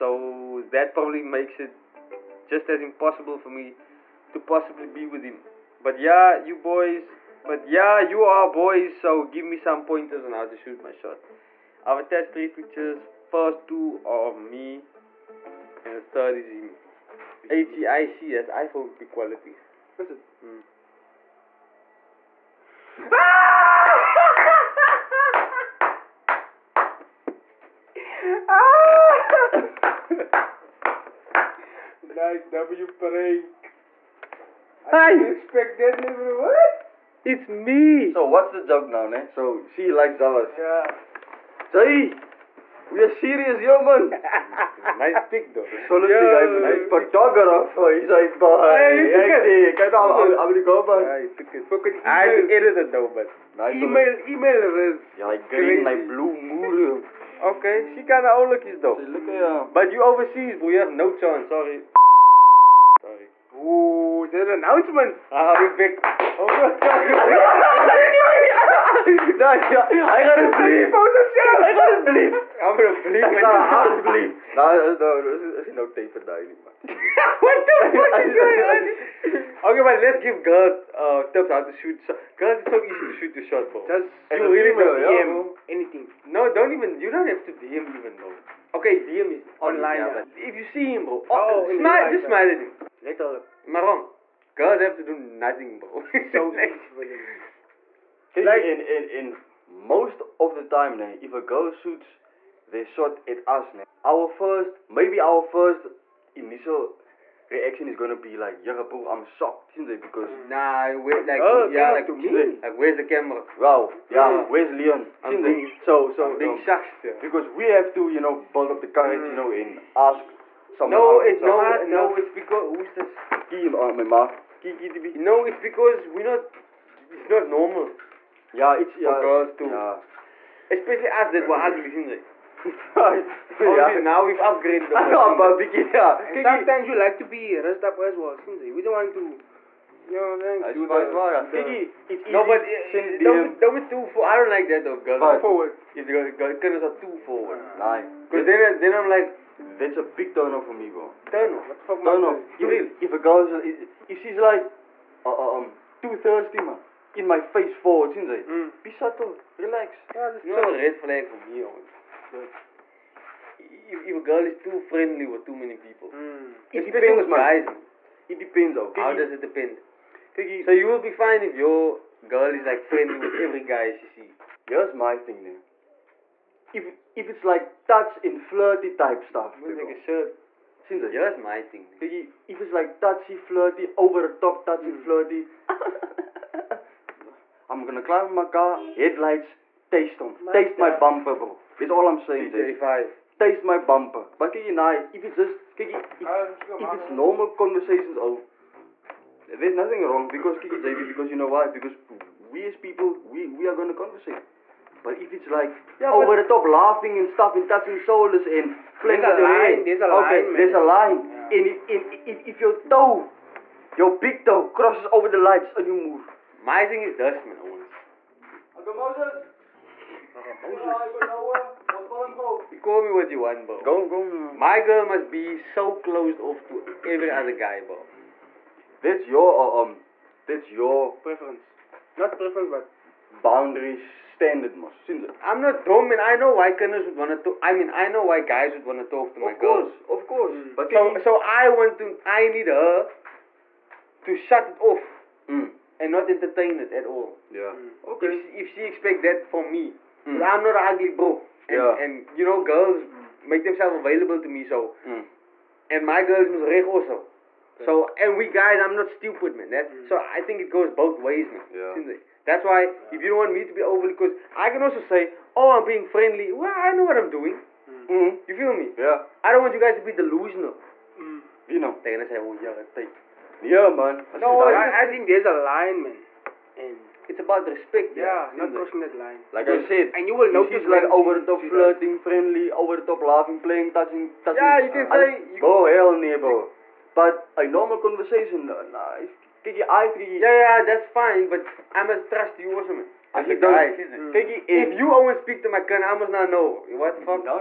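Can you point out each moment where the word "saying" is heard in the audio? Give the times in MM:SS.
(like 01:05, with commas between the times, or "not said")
02:21, 03:12.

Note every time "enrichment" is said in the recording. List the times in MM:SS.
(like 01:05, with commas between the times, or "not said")
not said.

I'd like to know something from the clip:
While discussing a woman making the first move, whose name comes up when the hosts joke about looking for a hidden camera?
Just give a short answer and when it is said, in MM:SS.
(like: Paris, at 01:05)
Leon, at 01:54.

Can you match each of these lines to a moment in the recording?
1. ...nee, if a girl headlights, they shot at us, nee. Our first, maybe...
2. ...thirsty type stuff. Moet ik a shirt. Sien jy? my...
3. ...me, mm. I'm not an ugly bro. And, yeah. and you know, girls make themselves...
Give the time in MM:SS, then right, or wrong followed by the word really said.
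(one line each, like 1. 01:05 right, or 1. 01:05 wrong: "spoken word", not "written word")
1. 01:40 wrong: "shoots", not "headlights"
2. 02:58 wrong: "flirty", not "thirsty"
3. 04:09 right.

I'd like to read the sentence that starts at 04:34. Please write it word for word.
no, it's just, I, I think there's a line, man.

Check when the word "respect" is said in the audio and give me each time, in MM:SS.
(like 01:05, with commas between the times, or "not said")
00:35, 04:37.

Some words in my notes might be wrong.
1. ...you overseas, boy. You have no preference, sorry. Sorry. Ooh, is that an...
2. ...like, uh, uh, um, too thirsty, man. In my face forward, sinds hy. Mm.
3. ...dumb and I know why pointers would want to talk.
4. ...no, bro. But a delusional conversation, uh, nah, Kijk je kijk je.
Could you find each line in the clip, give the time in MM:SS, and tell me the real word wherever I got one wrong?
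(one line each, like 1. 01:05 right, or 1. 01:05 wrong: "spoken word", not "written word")
1. 00:59 wrong: "chance", not "preference"
2. 02:34 right
3. 03:55 wrong: "kinders", not "pointers"
4. 04:46 wrong: "normal", not "delusional".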